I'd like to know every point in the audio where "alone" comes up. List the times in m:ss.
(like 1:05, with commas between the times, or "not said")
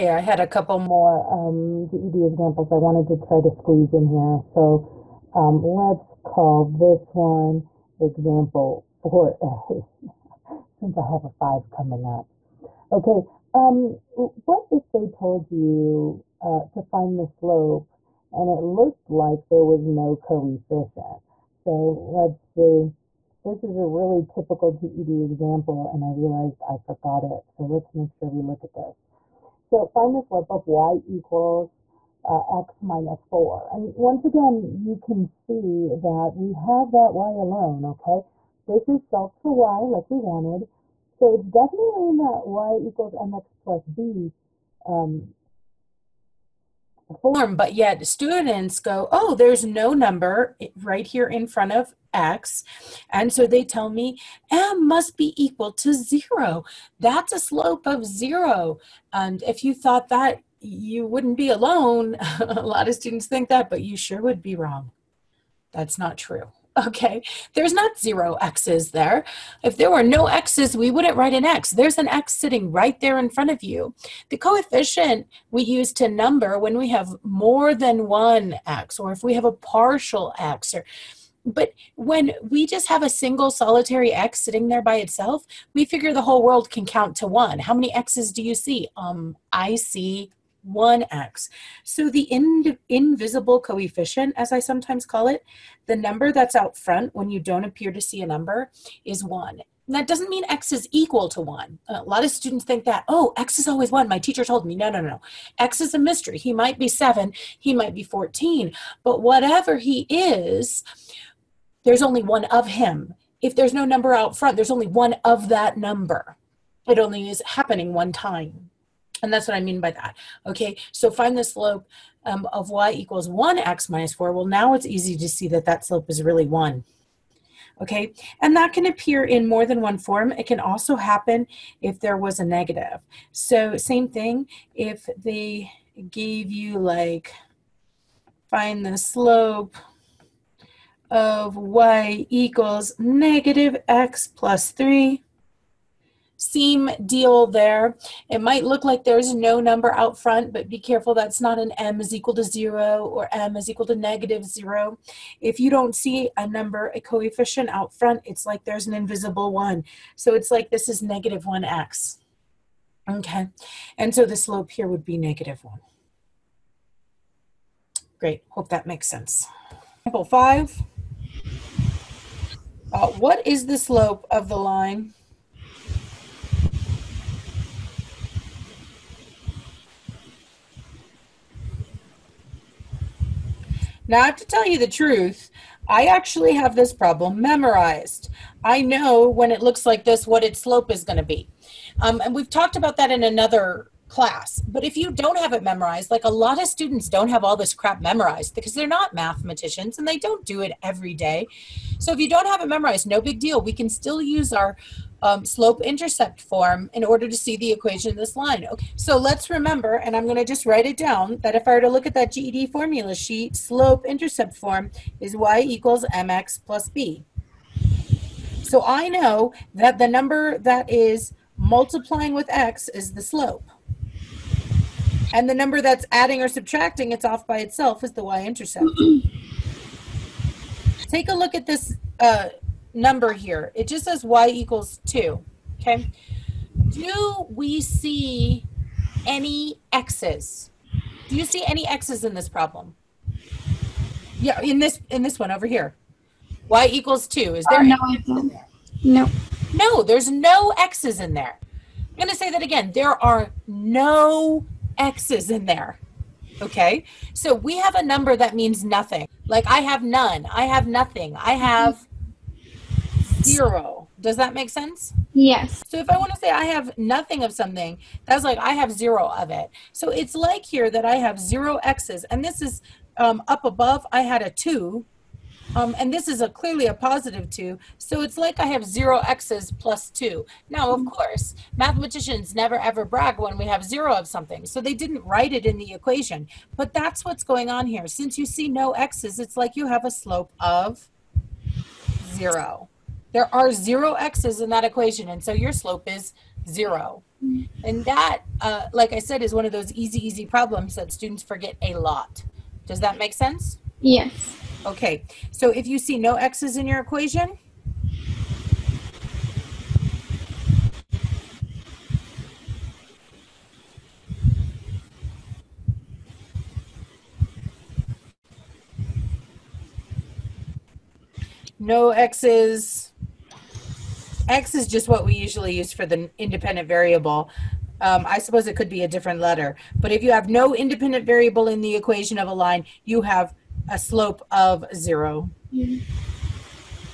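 0:37, 1:01.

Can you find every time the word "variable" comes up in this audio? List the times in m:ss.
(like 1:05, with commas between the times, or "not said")
5:26, 5:31.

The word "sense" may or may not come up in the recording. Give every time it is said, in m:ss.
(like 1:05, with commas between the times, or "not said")
2:49, 4:24, 5:03.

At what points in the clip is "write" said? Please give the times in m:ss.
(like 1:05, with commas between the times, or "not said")
1:11, 3:30, 4:45.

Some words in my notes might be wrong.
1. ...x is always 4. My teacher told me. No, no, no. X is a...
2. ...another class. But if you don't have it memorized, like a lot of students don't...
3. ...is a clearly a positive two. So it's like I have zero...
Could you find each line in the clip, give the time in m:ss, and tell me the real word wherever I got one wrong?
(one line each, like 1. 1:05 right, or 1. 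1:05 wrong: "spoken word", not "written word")
1. 1:43 wrong: "1", not "4"
2. 3:13 right
3. 4:36 right.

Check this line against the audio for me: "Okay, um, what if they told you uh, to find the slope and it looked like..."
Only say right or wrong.
right.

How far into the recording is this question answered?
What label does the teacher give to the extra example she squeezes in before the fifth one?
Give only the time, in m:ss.
0:07.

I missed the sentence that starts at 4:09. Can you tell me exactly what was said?
no no there's no x's in there i'm going to say that again there are no X's in there.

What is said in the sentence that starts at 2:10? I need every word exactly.
It can also happen if there was a negative.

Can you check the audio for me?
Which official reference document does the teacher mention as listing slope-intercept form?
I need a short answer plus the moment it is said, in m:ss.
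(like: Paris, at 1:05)
GED formula sheet, at 3:32.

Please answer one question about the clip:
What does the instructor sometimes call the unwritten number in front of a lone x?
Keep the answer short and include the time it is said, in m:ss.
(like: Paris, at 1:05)
invisible coefficient, at 1:32.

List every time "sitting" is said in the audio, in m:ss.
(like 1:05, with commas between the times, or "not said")
1:12, 1:24.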